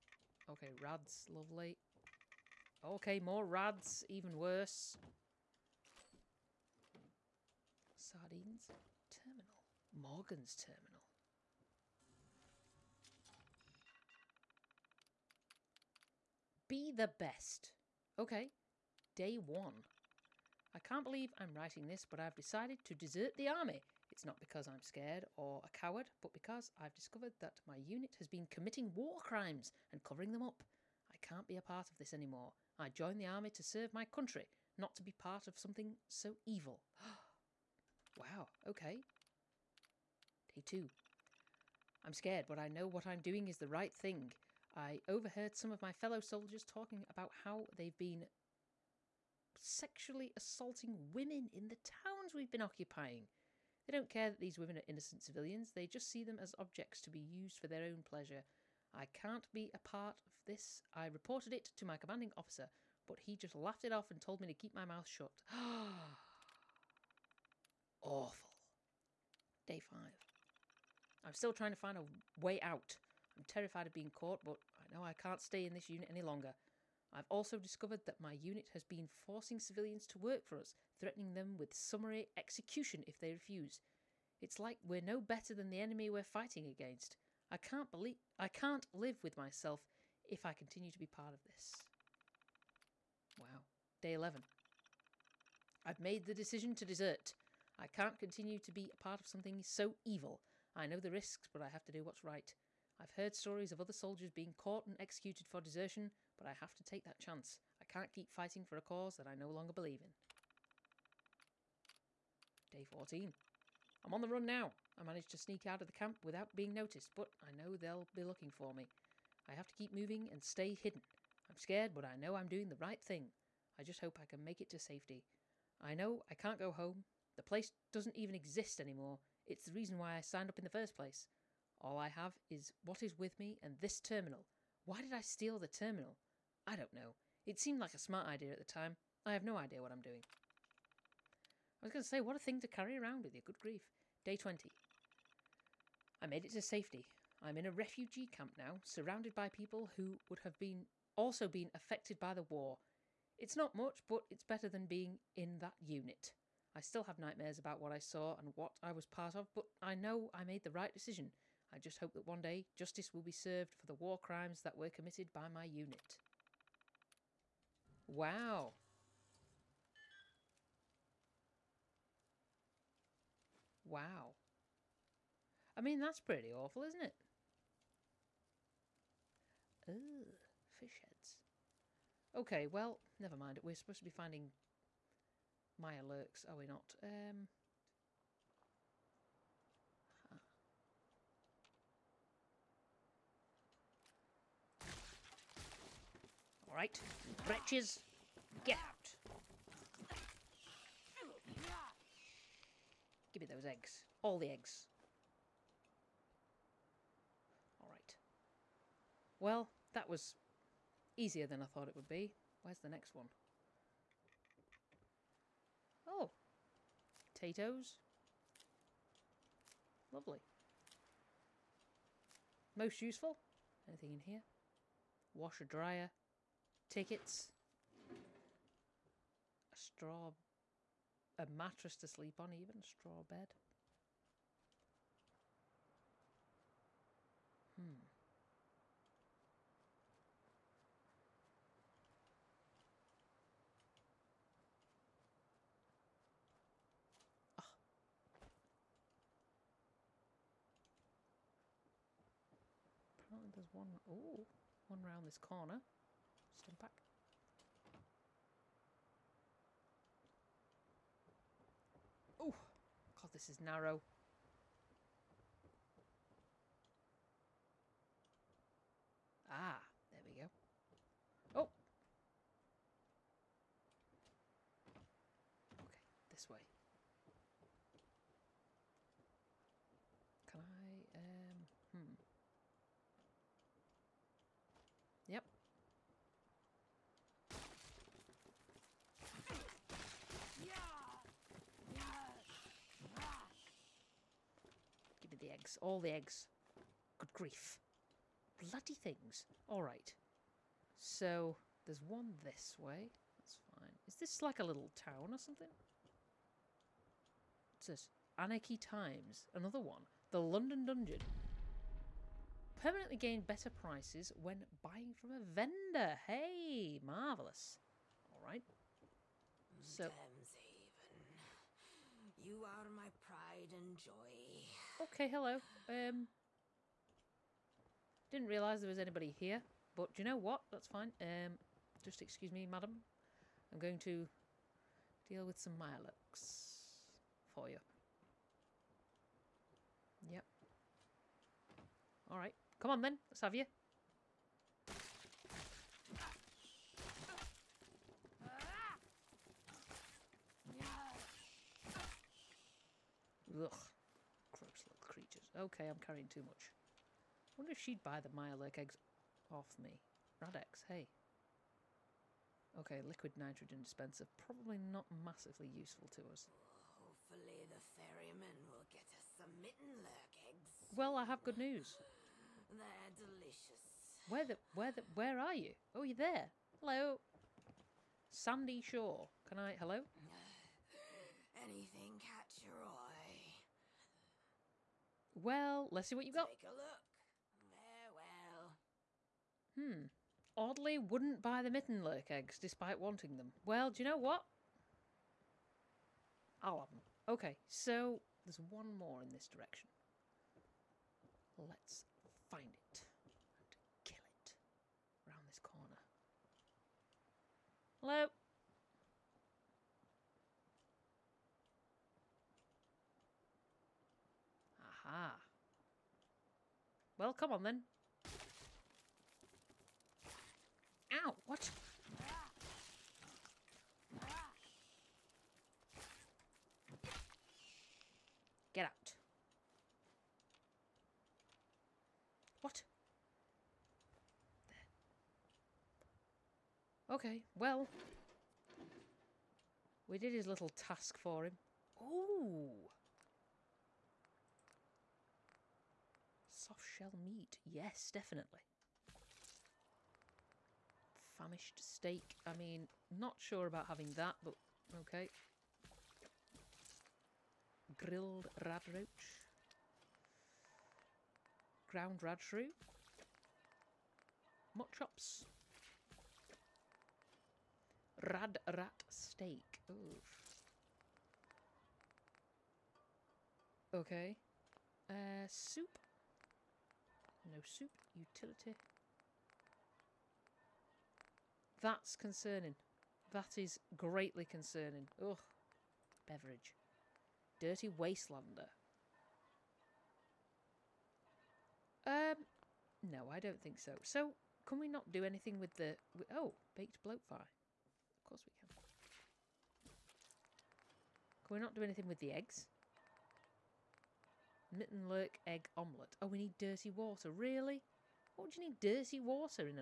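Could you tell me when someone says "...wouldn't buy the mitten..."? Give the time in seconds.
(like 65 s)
390 s.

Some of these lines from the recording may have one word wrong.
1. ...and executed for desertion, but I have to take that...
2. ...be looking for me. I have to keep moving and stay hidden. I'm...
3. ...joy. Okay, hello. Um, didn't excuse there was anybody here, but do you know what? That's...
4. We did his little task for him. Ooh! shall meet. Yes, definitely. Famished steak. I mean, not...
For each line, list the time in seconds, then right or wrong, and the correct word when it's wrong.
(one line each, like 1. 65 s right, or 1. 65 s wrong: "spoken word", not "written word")
1. 104 s right
2. 118 s right
3. 323 s wrong: "realise", not "excuse"
4. 440 s right.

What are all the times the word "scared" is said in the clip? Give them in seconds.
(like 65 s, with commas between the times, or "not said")
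24 s, 42 s, 121 s.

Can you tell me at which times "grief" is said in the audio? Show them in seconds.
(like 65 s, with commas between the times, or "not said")
143 s, 297 s.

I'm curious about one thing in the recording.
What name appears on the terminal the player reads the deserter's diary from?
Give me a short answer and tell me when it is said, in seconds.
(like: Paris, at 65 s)
Morgan, at 9 s.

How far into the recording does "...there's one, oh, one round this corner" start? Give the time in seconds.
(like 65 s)
253 s.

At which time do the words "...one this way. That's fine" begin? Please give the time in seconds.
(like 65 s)
302 s.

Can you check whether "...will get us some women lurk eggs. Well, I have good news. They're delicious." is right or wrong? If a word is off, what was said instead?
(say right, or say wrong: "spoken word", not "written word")
wrong: "mitten", not "women".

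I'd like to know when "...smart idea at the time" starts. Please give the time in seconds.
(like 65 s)
137 s.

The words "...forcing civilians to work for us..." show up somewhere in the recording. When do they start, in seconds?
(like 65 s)
79 s.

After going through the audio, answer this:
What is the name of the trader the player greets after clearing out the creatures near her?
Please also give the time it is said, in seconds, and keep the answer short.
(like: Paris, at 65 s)
Sandy Shore, at 378 s.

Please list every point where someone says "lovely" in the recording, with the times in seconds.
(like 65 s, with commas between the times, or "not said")
1 s, 220 s.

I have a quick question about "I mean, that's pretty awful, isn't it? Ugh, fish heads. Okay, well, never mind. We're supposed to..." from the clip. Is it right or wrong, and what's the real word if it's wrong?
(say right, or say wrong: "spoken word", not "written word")
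right.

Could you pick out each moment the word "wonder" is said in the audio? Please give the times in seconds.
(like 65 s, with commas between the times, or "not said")
357 s.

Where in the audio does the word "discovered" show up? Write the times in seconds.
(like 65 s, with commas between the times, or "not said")
26 s, 77 s.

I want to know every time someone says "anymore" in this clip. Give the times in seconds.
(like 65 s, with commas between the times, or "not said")
32 s, 128 s.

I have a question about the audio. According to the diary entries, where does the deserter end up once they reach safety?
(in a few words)
A refugee camp.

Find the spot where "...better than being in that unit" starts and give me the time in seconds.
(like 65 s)
154 s.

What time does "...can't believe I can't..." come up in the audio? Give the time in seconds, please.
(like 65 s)
87 s.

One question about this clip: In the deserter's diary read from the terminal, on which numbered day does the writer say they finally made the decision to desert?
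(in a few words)
Day 11.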